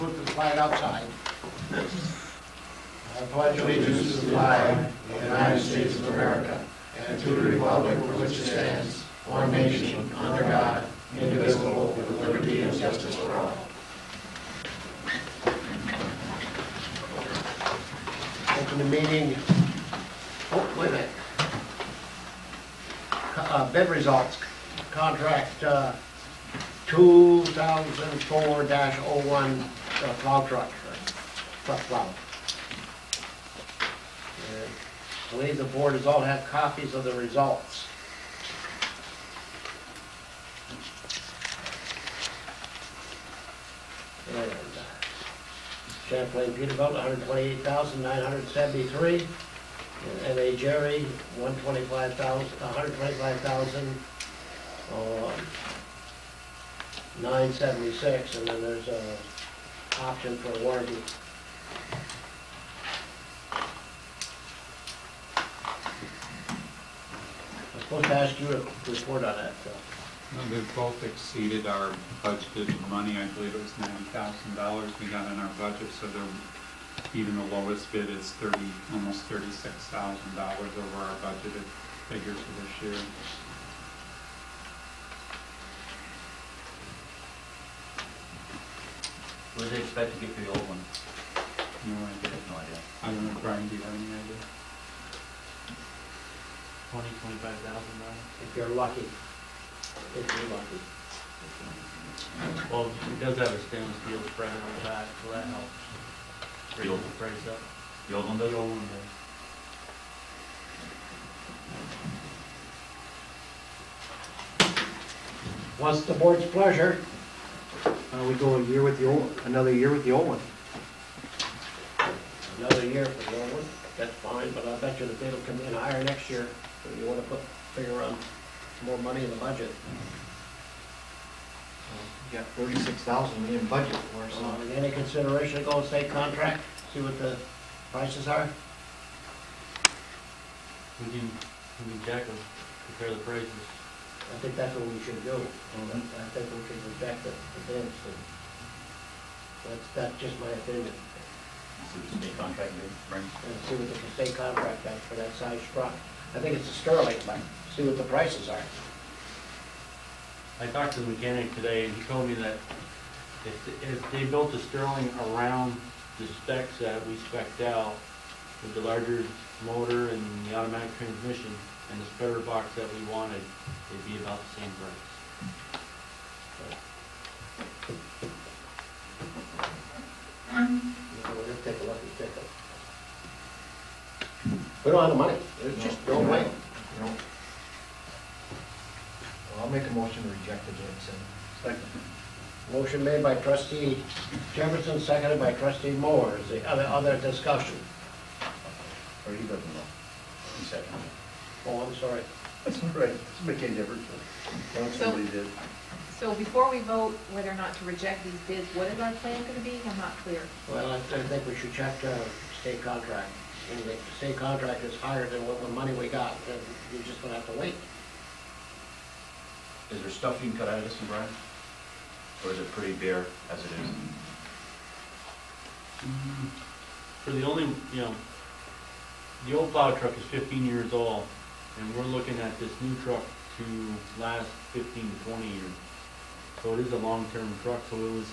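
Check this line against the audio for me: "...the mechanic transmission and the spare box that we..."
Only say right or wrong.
wrong.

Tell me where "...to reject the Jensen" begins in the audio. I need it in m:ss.
3:10.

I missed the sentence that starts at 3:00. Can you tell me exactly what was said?
We'll just take a look at pickup.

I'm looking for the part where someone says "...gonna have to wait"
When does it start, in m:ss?
3:37.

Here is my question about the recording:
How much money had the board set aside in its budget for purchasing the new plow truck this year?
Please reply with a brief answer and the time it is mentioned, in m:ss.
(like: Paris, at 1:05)
$90,000, at 1:13.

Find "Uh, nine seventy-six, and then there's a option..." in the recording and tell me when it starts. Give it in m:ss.
0:54.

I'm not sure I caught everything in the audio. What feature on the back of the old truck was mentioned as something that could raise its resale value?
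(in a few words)
Stainless steel spreader.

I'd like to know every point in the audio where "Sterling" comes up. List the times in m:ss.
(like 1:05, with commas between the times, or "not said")
2:36, 2:44.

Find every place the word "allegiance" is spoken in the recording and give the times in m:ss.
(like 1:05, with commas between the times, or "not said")
0:03.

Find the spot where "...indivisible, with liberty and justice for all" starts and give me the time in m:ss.
0:11.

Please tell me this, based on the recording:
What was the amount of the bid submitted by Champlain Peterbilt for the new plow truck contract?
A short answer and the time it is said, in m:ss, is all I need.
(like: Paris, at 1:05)
$128,973, at 0:46.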